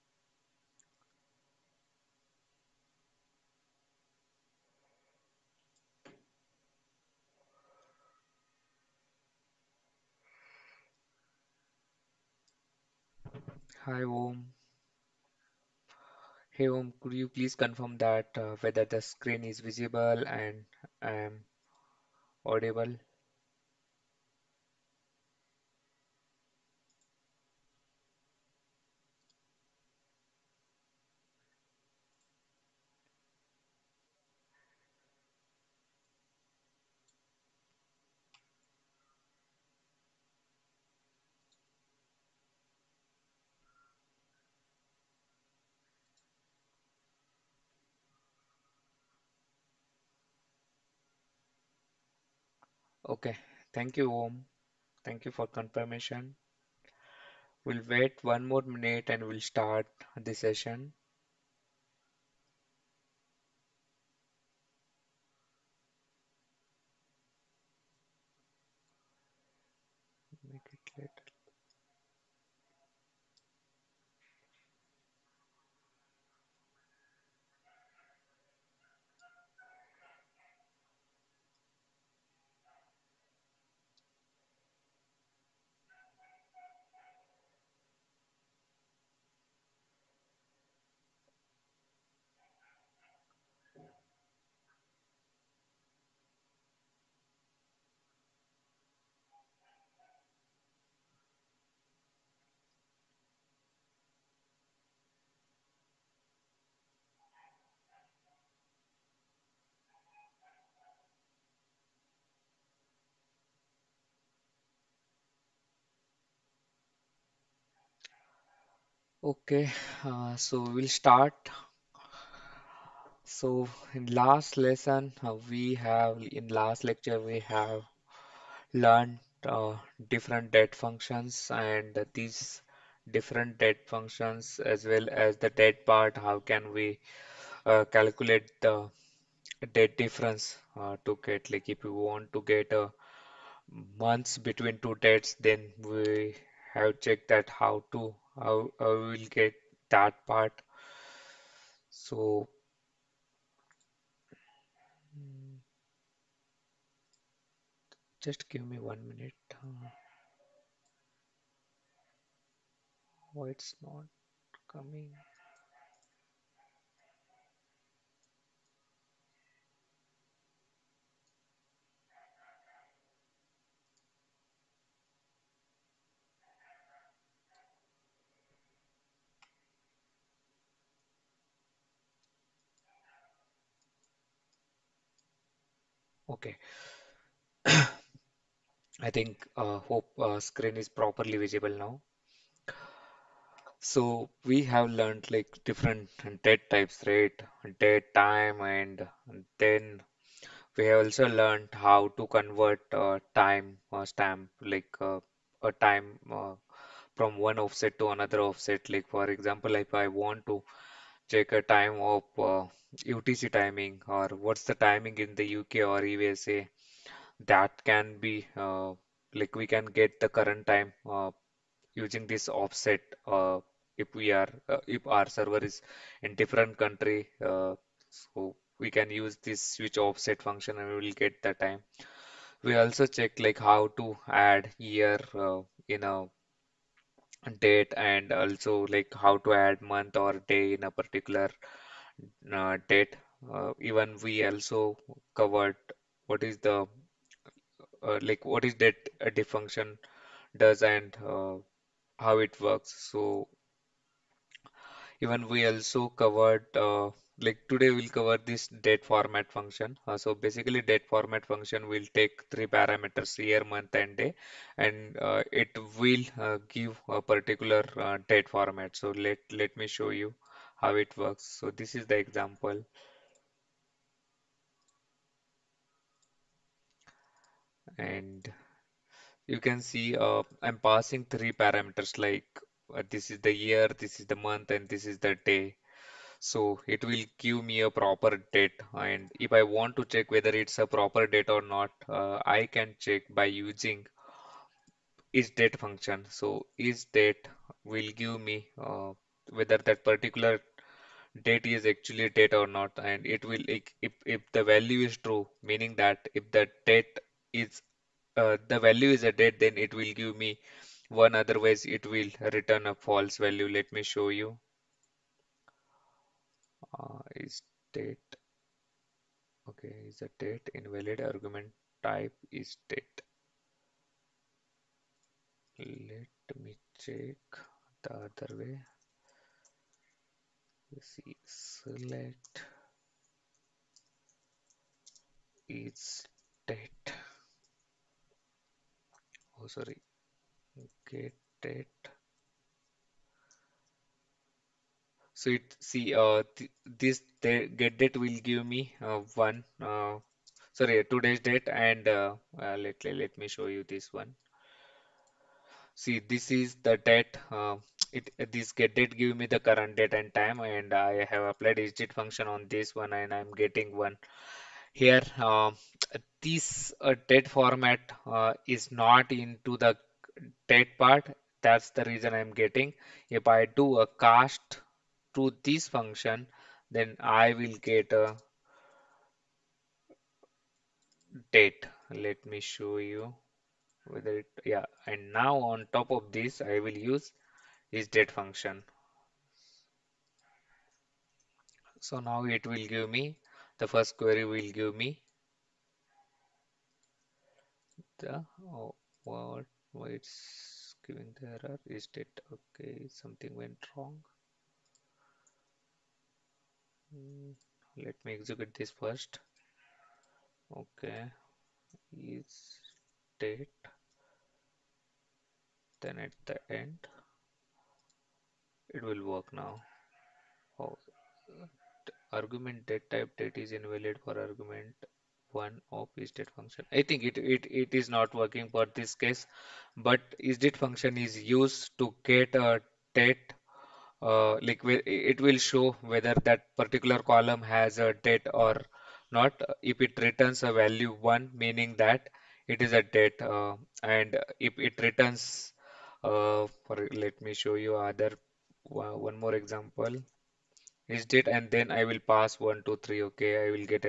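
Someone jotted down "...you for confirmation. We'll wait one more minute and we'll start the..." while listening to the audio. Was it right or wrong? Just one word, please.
right.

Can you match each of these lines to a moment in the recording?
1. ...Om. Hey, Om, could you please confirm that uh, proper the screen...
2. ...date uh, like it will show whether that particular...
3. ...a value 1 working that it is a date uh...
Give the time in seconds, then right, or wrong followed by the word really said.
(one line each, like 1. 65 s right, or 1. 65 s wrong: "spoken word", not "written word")
1. 14 s wrong: "whether", not "proper"
2. 433 s right
3. 440 s wrong: "meaning", not "working".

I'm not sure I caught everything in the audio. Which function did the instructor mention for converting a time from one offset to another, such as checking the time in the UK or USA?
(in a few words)
switch offset.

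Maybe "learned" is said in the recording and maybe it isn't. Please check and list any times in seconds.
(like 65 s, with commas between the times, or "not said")
128 s, 194 s, 201 s.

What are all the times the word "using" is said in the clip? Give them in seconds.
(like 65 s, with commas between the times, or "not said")
221 s, 293 s.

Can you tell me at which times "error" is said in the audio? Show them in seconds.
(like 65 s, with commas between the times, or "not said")
401 s.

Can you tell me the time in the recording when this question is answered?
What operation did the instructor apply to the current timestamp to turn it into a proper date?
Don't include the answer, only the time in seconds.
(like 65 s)
374 s.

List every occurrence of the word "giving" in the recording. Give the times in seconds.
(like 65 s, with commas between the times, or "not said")
401 s.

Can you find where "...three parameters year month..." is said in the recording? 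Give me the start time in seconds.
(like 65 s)
262 s.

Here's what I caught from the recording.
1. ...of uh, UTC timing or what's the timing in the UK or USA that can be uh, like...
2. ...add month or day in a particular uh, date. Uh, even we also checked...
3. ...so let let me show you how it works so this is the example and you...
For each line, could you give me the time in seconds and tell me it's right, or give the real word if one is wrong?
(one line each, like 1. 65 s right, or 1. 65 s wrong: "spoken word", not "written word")
1. 212 s right
2. 239 s wrong: "covered", not "checked"
3. 268 s right.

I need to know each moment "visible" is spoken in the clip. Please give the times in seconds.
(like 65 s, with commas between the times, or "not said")
19 s, 191 s.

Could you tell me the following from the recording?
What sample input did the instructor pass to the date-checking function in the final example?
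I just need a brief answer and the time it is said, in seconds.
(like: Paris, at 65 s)
1 2 3, at 452 s.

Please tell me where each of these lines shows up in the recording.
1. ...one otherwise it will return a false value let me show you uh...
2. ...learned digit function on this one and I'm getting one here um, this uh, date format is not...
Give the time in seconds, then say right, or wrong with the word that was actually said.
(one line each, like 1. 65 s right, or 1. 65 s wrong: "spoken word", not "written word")
1. 311 s right
2. 361 s wrong: "applied", not "learned".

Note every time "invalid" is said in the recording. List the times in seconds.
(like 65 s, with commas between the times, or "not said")
320 s, 423 s.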